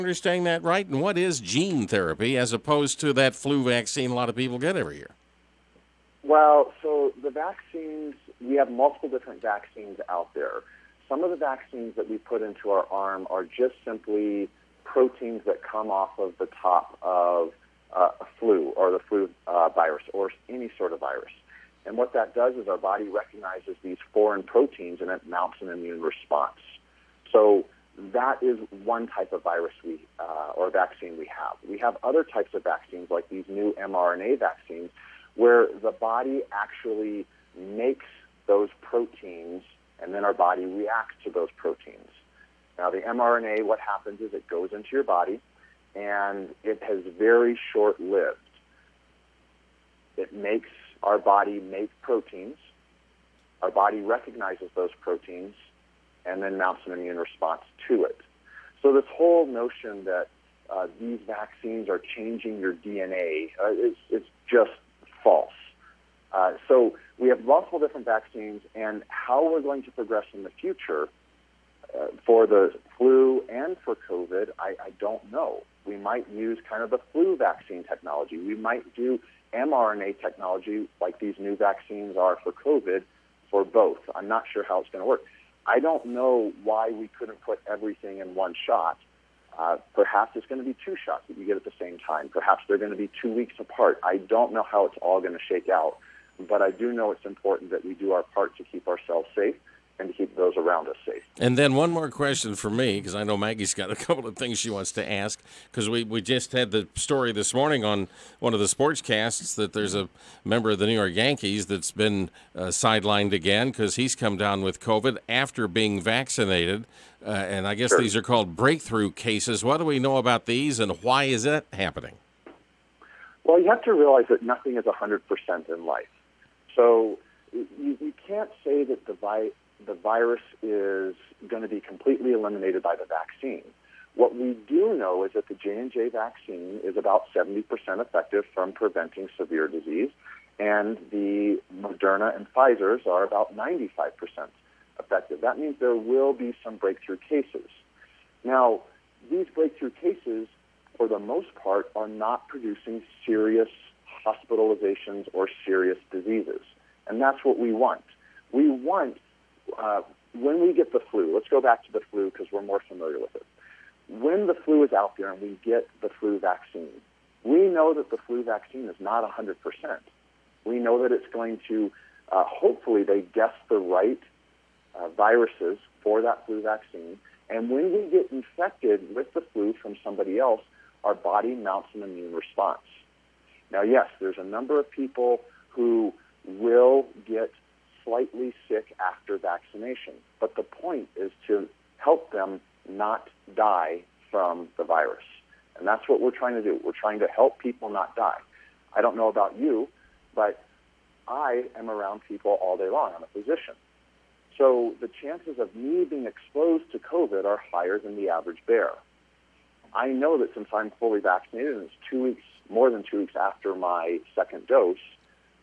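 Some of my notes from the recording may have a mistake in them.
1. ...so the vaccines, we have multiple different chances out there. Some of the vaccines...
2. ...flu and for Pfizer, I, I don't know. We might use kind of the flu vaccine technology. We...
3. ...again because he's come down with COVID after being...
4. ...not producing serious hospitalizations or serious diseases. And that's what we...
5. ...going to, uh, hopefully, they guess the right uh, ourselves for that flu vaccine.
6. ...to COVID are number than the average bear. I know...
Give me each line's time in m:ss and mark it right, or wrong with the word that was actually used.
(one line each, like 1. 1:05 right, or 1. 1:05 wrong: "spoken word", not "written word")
1. 0:06 wrong: "vaccines", not "chances"
2. 1:12 wrong: "COVID", not "Pfizer"
3. 1:53 right
4. 2:32 right
5. 2:51 wrong: "viruses", not "ourselves"
6. 3:26 wrong: "higher", not "number".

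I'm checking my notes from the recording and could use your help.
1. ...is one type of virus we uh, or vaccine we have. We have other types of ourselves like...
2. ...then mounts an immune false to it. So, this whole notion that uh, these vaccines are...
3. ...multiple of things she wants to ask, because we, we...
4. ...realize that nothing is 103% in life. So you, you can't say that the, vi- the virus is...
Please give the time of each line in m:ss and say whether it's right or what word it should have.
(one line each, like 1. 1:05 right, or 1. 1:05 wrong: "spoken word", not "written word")
1. 0:28 wrong: "vaccines", not "ourselves"
2. 0:56 wrong: "response", not "false"
3. 1:43 wrong: "couple", not "multiple"
4. 2:03 wrong: "100", not "103".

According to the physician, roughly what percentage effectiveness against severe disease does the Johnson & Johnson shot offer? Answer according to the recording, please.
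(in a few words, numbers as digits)
70%.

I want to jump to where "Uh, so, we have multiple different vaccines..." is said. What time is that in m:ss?
1:06.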